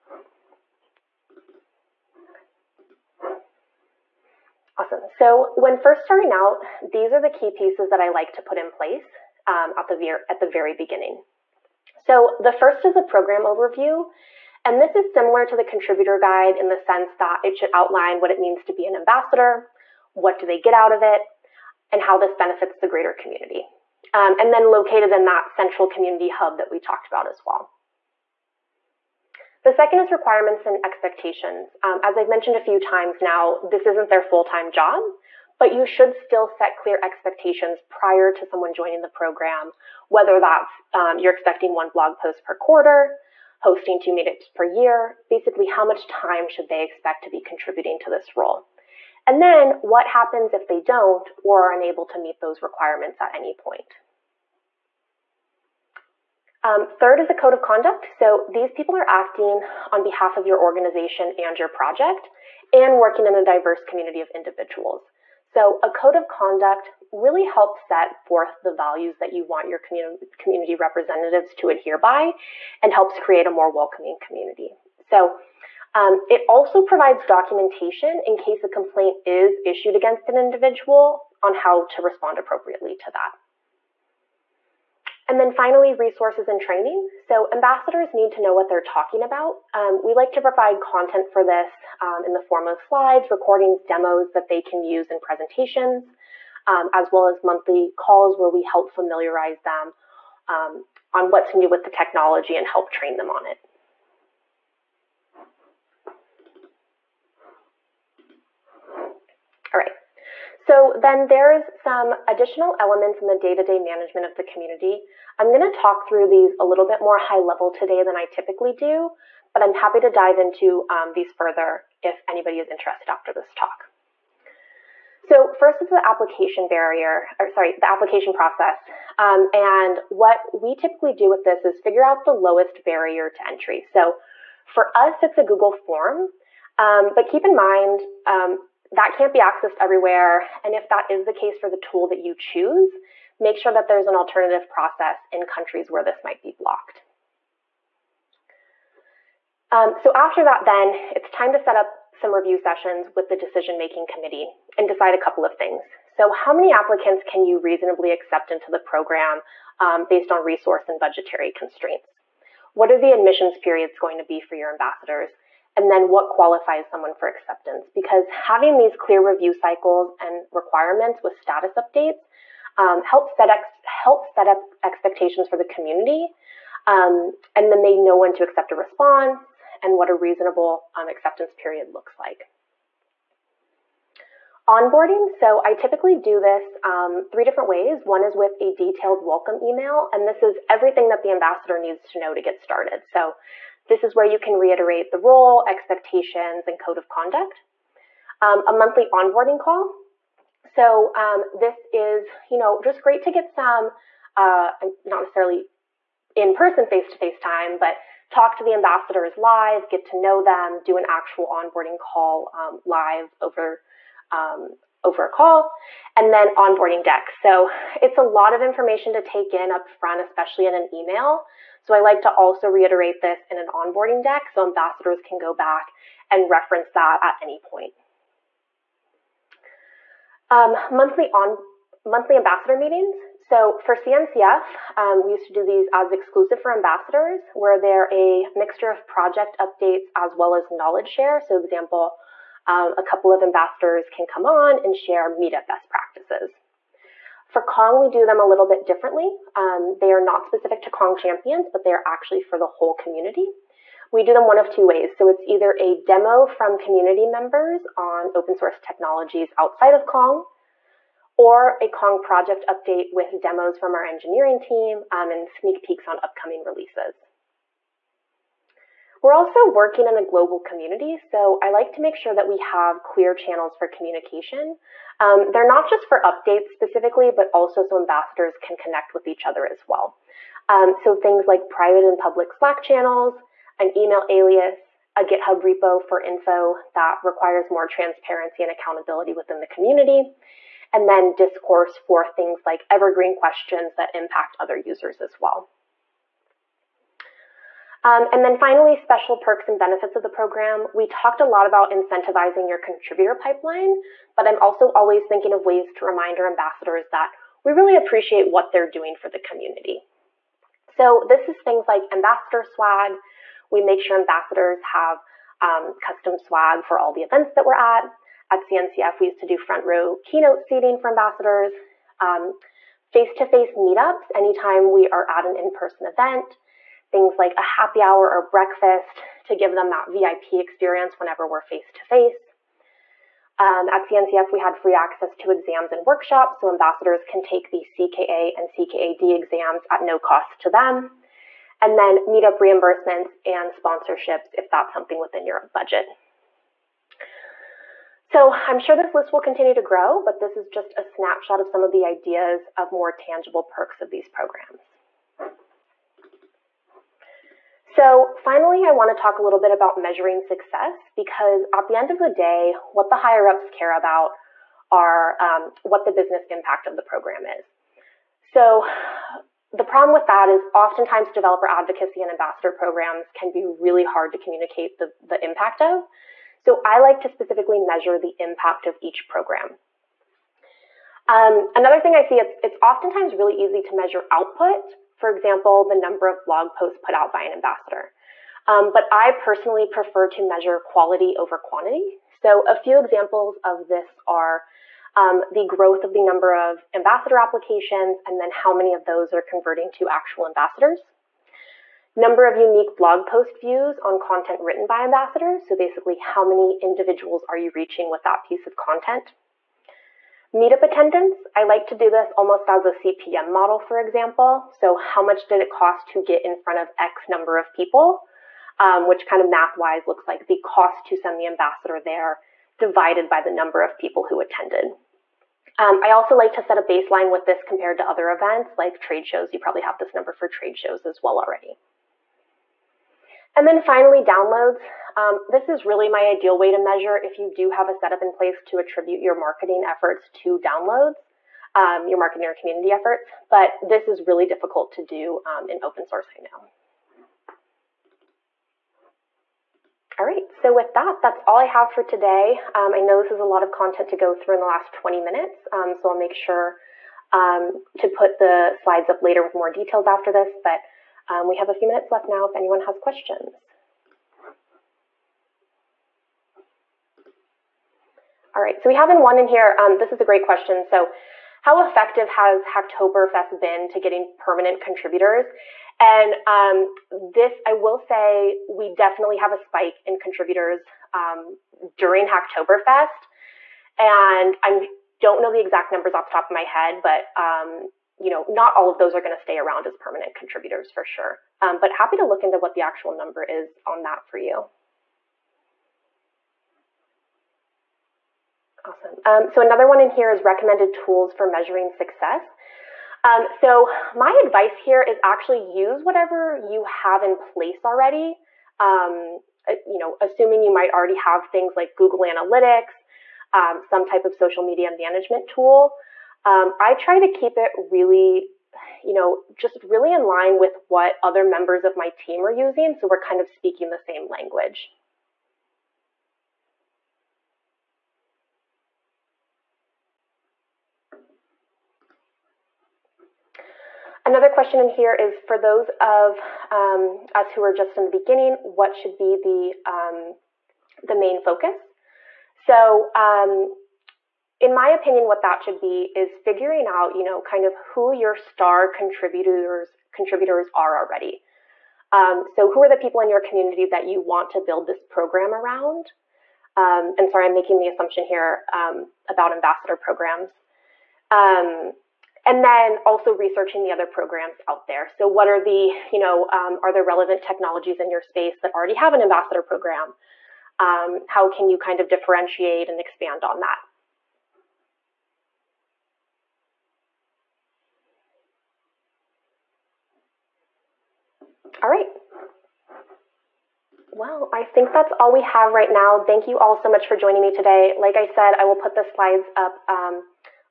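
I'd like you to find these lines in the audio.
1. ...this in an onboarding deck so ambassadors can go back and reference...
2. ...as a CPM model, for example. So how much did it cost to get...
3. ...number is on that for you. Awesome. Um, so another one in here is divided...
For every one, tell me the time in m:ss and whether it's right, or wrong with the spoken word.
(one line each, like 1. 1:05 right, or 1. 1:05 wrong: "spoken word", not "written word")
1. 3:43 right
2. 6:52 right
3. 8:13 wrong: "recommended", not "divided".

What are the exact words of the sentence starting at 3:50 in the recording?
Um, monthly on monthly ambassador meetings.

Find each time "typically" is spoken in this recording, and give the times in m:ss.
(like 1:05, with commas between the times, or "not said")
1:58, 2:10, 3:05.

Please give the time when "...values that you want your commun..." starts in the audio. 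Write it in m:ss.
1:08.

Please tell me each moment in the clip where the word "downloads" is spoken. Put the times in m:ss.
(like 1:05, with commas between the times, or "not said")
7:14, 7:20.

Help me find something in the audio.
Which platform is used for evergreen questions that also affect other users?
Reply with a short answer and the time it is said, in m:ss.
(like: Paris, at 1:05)
Discourse, at 4:51.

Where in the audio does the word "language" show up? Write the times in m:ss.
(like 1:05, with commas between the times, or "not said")
8:44.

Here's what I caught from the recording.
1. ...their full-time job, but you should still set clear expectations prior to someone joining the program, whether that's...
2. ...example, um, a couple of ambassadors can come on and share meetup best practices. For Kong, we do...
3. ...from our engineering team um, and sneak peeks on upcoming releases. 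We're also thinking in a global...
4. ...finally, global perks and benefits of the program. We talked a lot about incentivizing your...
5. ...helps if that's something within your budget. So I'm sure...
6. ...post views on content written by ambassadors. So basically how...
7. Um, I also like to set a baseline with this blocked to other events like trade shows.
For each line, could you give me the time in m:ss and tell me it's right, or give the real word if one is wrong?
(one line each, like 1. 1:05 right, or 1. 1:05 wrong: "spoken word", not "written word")
1. 0:34 right
2. 4:01 right
3. 4:23 wrong: "working", not "thinking"
4. 4:58 wrong: "special", not "global"
5. 5:43 wrong: "sponsorships", not "helps"
6. 6:43 right
7. 7:05 wrong: "compared", not "blocked".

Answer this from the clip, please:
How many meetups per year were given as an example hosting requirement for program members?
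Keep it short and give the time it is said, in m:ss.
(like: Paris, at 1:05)
2, at 0:43.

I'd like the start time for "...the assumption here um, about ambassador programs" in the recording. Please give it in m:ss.
9:17.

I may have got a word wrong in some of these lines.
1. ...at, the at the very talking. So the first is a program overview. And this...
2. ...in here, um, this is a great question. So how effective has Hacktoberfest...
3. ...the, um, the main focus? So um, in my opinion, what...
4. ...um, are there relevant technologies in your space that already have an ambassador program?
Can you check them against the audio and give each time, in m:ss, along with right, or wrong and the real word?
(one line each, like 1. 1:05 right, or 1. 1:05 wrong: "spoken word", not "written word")
1. 0:09 wrong: "beginning", not "talking"
2. 7:49 right
3. 8:59 right
4. 9:26 right.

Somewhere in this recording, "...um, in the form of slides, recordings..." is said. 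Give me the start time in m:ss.
1:32.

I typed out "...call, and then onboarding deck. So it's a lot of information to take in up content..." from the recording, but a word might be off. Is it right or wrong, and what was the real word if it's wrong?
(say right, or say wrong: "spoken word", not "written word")
wrong: "front", not "content".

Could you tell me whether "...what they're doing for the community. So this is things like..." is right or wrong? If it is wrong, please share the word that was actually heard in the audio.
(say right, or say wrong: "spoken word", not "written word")
right.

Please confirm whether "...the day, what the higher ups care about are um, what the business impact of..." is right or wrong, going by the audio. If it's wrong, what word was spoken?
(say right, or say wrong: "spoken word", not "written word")
right.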